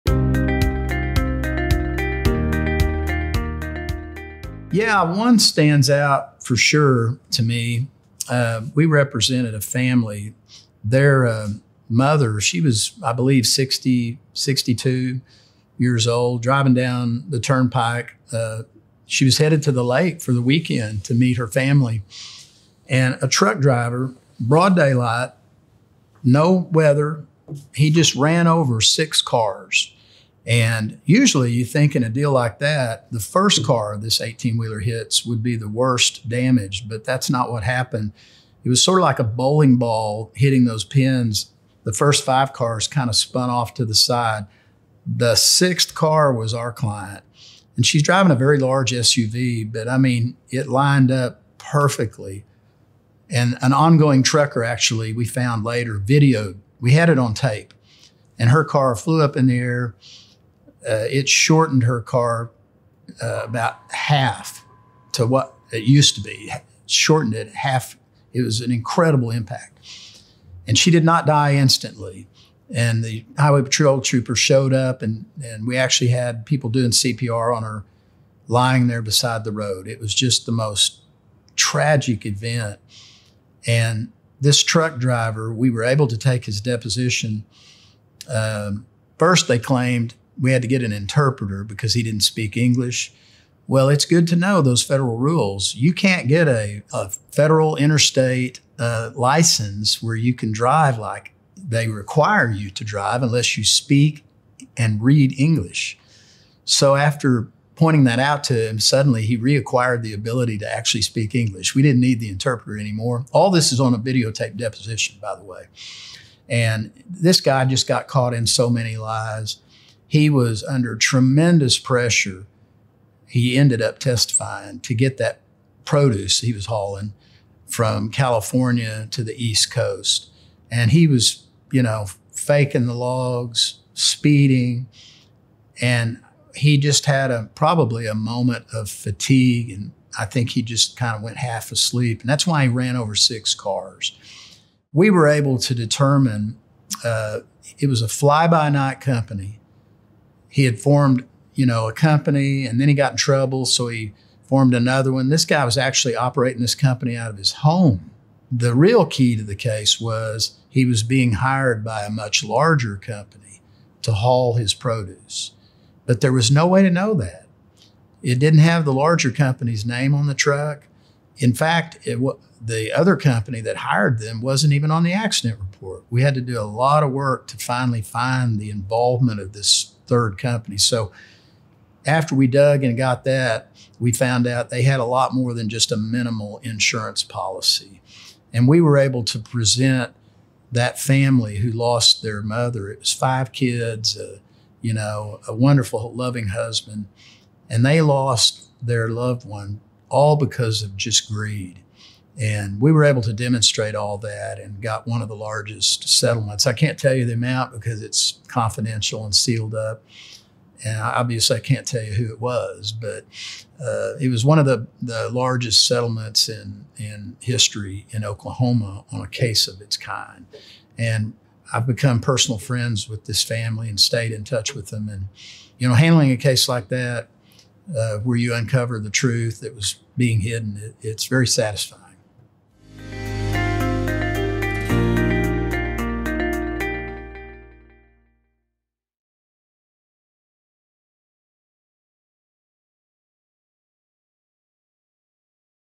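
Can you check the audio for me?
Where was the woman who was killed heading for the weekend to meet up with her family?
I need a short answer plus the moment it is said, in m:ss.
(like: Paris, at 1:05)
the lake, at 0:19.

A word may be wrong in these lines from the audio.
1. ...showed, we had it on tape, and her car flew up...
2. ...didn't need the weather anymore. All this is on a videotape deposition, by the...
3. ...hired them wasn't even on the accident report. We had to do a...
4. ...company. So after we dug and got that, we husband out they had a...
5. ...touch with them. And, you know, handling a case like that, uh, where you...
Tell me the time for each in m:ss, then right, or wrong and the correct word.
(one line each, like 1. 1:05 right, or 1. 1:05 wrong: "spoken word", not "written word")
1. 0:55 wrong: "videoed", not "showed"
2. 1:51 wrong: "interpreter", not "weather"
3. 2:53 right
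4. 3:00 wrong: "found", not "husband"
5. 3:44 right.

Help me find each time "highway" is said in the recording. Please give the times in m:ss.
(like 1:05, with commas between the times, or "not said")
1:13.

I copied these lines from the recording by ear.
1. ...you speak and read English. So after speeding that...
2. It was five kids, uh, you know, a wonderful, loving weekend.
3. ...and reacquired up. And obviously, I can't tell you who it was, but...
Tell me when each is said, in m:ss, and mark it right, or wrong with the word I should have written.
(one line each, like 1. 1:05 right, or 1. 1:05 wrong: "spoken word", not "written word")
1. 1:43 wrong: "pointing", not "speeding"
2. 3:12 wrong: "husband", not "weekend"
3. 3:29 wrong: "sealed", not "reacquired".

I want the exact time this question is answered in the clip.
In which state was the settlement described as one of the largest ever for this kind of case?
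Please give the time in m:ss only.
3:38.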